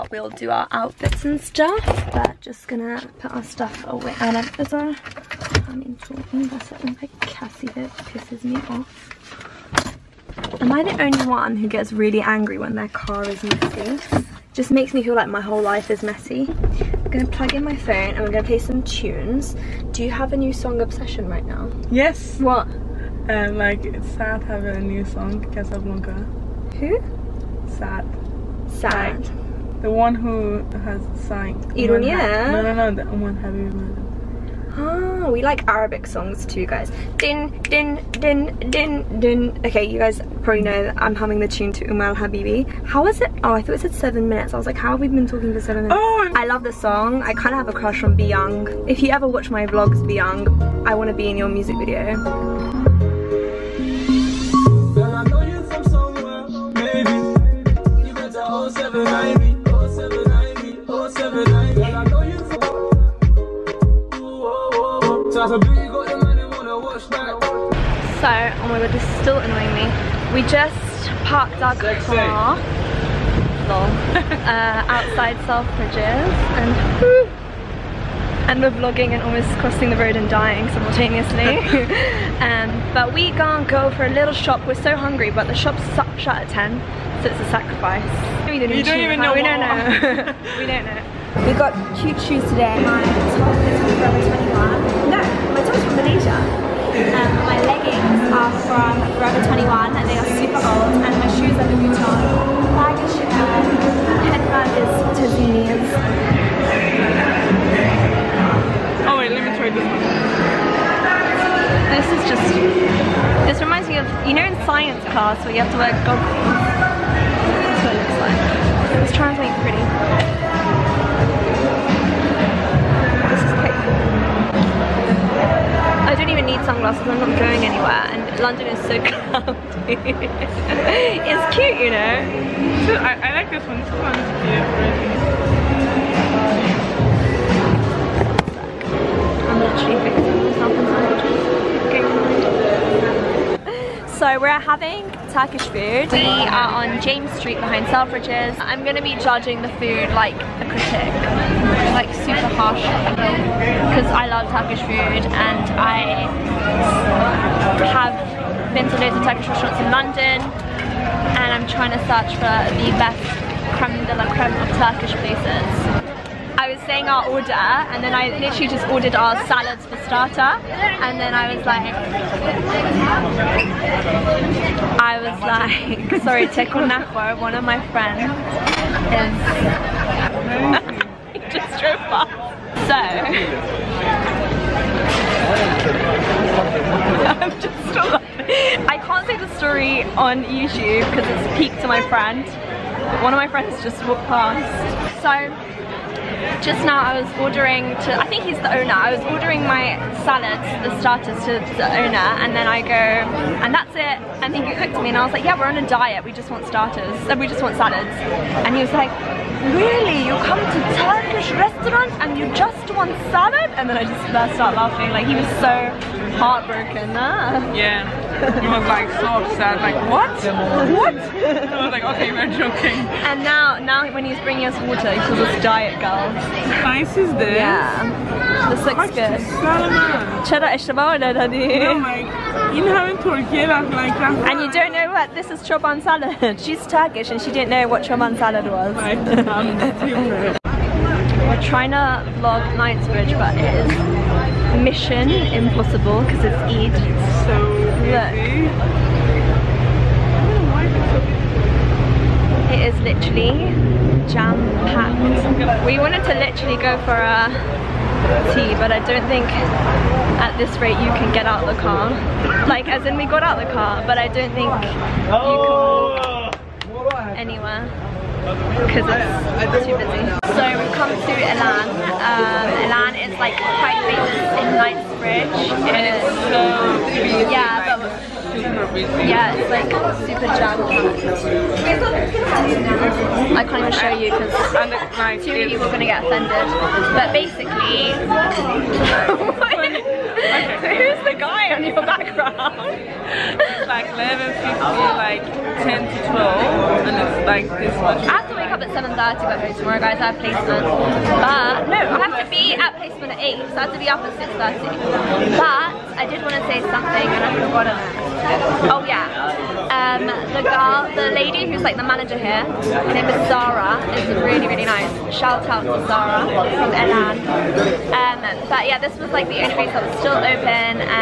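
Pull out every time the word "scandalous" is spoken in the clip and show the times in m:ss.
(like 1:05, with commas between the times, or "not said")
not said.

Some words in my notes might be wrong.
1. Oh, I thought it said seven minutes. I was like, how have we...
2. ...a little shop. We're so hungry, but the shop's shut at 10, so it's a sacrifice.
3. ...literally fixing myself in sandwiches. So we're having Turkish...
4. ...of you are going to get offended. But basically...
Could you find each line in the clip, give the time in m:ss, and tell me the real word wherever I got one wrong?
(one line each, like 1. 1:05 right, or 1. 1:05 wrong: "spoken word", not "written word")
1. 0:43 right
2. 1:24 right
3. 2:19 right
4. 4:45 right.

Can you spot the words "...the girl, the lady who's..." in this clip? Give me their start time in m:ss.
5:10.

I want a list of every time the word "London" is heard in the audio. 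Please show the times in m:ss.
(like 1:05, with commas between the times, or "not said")
2:08, 2:39.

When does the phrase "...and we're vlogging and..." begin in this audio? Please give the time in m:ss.
1:18.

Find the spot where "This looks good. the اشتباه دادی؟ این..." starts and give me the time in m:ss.
3:48.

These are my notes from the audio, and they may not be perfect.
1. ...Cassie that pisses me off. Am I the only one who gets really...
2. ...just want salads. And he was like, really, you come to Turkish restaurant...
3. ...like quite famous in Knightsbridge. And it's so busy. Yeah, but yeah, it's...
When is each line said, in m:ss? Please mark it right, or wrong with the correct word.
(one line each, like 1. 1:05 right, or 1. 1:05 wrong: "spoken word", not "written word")
1. 0:07 right
2. 3:27 right
3. 4:33 right.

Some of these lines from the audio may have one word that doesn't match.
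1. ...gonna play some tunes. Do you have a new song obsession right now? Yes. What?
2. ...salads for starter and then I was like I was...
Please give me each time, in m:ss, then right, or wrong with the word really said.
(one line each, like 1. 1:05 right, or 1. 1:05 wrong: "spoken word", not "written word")
1. 0:18 right
2. 2:49 right.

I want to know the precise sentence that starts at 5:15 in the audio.
Shout out to Zara from EL&N.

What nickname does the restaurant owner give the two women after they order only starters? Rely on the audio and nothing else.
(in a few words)
diet girls.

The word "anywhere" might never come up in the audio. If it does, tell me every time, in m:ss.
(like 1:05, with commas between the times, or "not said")
2:07, 4:27.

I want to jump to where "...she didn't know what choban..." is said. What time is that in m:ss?
3:57.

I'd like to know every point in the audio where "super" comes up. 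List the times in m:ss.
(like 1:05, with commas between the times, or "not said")
2:32, 4:40.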